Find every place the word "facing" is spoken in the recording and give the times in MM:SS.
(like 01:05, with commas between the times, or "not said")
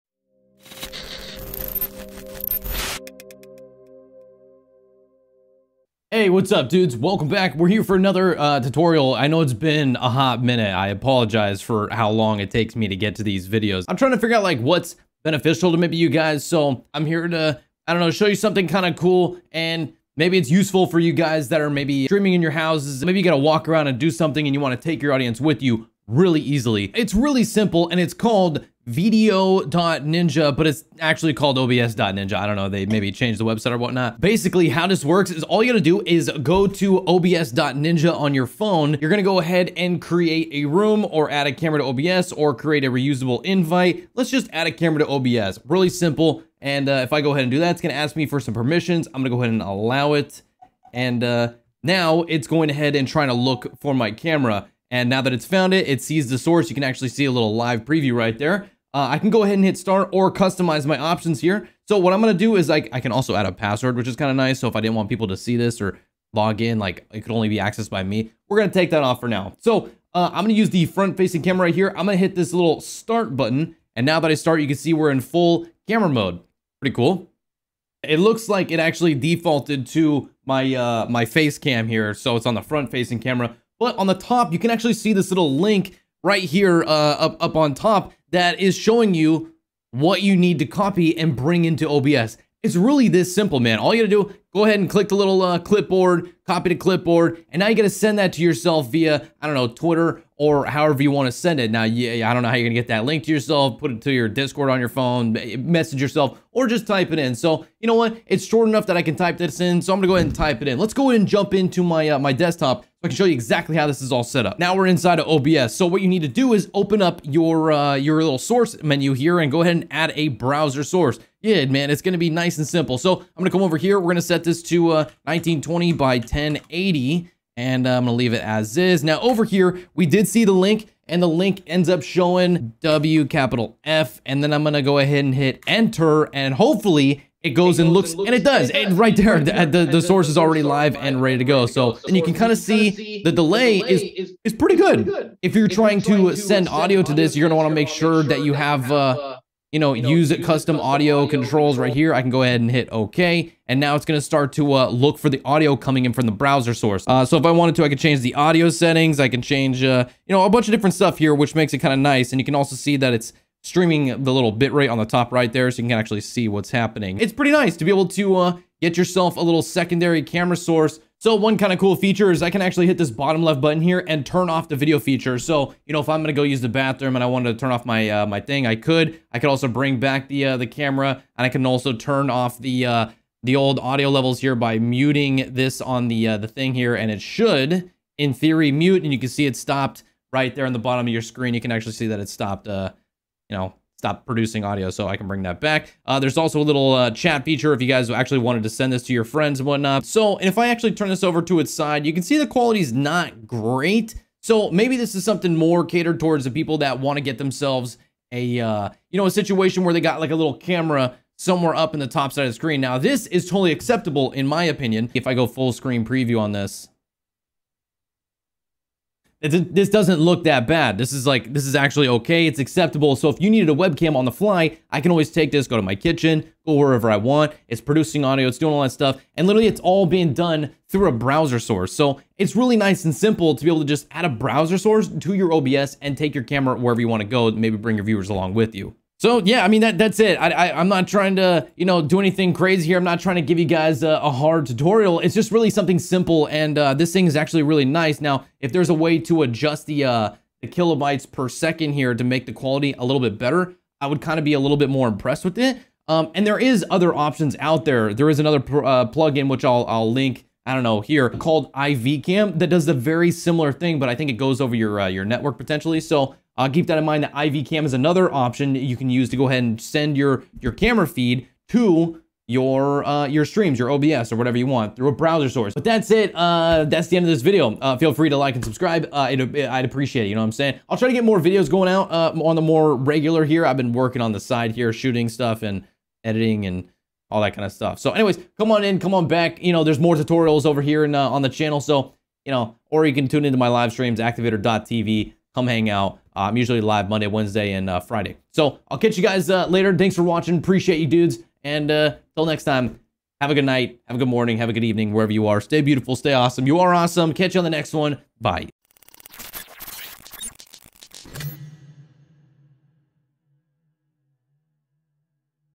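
01:11, 01:22.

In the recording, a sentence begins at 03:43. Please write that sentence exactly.
So if you needed a webcam on the fly, I can always take this, go to my kitchen, go wherever I want.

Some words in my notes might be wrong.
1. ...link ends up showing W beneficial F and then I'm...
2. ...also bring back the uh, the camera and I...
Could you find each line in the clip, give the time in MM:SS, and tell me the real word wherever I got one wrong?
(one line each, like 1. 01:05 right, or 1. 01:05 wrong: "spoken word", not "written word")
1. 02:11 wrong: "capital", not "beneficial"
2. 02:59 right.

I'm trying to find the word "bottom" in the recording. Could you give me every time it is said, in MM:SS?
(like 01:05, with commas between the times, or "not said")
02:53, 03:10.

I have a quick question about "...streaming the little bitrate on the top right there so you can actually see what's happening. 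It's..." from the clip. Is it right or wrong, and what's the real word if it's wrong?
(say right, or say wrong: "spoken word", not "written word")
right.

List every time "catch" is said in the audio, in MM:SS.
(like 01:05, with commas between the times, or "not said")
04:58, 05:07.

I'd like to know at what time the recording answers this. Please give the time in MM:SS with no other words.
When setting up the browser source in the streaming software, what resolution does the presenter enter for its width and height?
02:05.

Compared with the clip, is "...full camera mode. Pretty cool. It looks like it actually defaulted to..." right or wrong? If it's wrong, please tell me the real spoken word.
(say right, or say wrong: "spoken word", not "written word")
right.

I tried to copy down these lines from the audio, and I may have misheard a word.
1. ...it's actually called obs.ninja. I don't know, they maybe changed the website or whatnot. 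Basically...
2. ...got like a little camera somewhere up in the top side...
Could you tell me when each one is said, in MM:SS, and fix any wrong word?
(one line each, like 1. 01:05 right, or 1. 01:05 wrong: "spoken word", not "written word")
1. 00:30 right
2. 03:30 right.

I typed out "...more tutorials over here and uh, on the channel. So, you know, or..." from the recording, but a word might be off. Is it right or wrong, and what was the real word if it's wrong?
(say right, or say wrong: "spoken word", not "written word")
right.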